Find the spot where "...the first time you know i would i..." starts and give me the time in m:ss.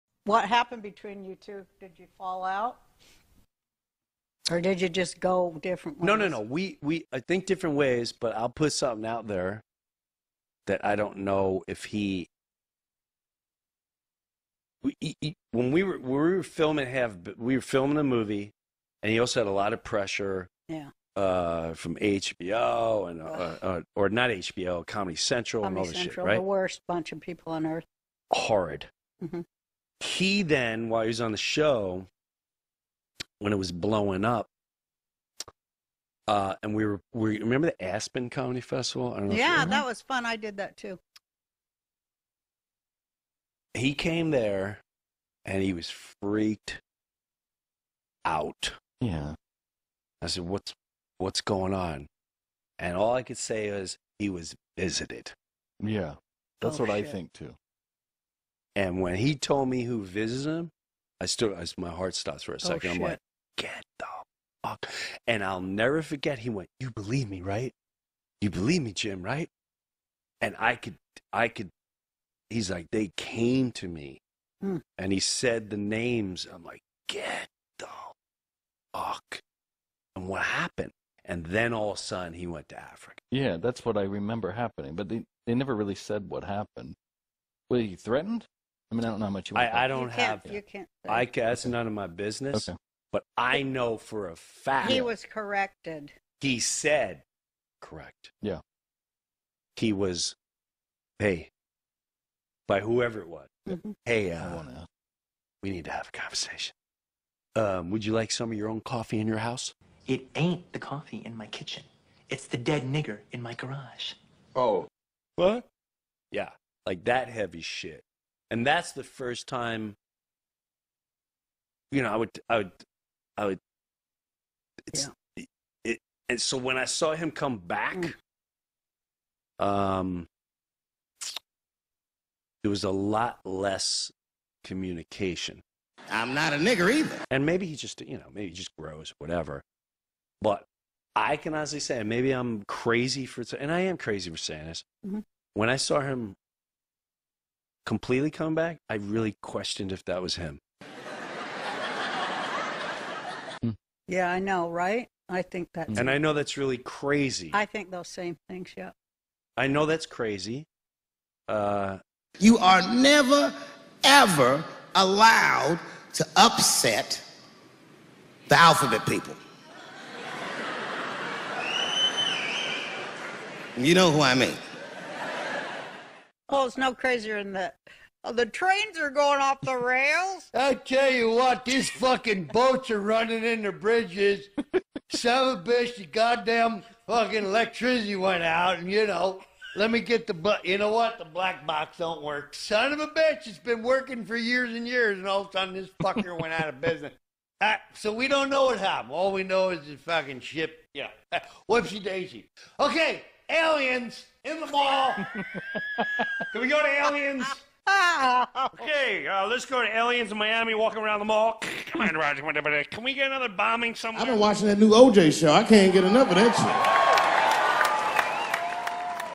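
1:58.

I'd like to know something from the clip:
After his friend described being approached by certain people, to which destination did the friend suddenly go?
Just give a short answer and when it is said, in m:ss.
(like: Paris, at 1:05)
Africa, at 1:22.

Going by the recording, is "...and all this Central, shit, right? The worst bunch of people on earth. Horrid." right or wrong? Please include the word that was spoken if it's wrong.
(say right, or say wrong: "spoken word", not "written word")
right.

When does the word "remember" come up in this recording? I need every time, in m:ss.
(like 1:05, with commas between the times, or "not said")
0:37, 1:24.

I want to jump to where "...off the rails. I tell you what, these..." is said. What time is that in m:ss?
2:59.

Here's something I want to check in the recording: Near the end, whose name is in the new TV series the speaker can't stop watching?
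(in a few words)
OJ.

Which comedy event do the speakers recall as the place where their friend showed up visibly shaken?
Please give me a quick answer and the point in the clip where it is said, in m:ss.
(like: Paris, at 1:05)
Aspen Comedy Festival, at 0:37.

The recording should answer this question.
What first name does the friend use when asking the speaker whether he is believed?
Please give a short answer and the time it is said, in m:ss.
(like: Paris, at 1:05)
Jim, at 1:08.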